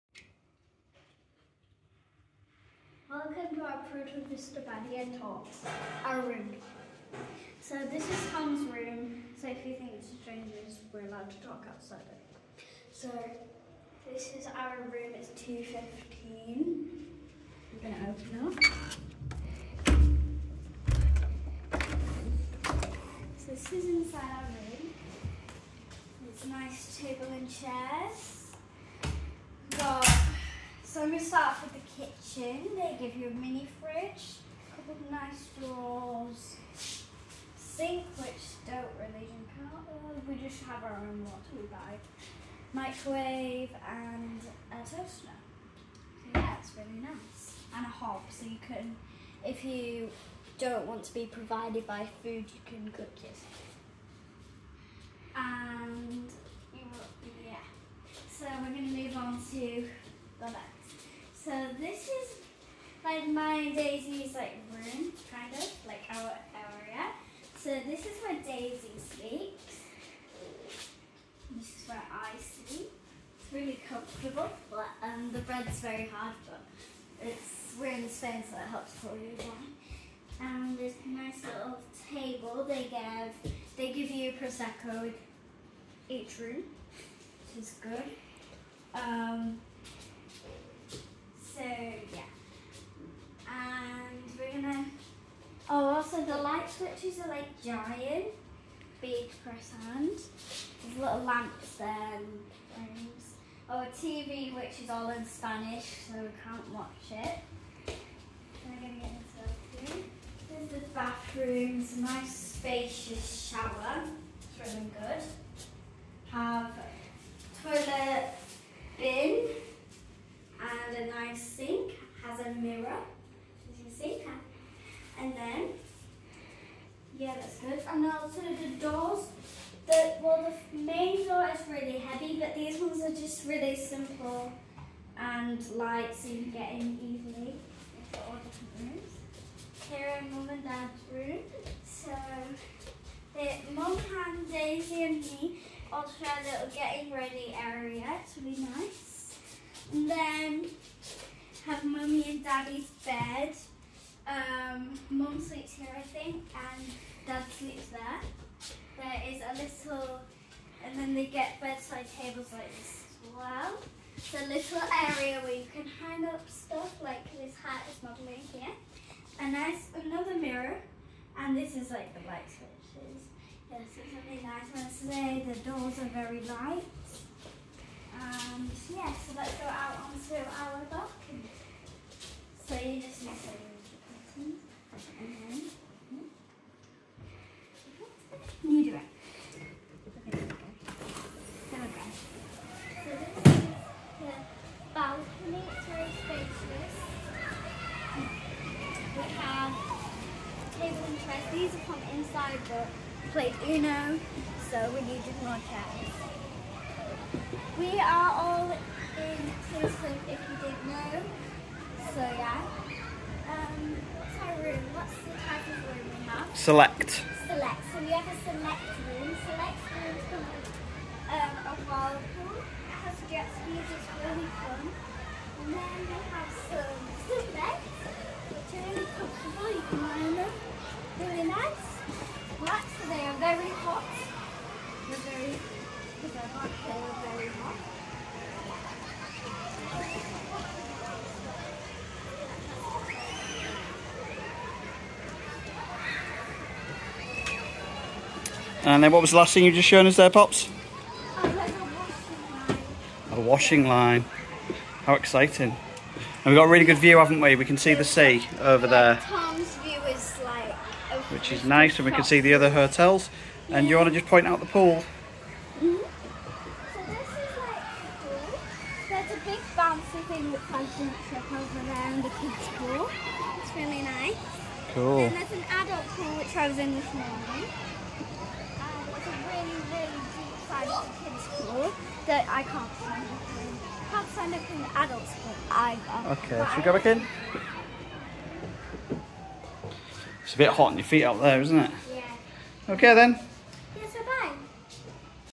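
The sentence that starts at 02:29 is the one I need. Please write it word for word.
And then have mummy and daddy's bed.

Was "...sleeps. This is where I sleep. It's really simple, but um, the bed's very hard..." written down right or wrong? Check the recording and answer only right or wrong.
wrong.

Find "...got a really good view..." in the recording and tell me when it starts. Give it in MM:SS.
04:16.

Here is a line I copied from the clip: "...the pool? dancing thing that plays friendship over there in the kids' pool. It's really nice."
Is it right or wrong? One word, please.
right.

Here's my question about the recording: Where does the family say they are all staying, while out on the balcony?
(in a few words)
Kingscliff.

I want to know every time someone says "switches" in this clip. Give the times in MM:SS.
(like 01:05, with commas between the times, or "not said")
01:36, 02:52.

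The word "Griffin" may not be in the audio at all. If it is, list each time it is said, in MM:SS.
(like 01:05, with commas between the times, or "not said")
not said.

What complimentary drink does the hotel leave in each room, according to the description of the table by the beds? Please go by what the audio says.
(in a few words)
Prosecco.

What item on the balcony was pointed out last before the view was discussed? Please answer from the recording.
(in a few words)
A washing line.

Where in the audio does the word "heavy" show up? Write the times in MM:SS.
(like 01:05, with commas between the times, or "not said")
02:11.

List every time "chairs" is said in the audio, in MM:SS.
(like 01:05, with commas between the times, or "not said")
00:27, 03:25.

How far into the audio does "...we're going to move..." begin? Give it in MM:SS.
00:58.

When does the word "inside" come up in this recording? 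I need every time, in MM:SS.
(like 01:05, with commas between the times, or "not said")
00:23, 03:22.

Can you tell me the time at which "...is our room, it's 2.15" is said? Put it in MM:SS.
00:14.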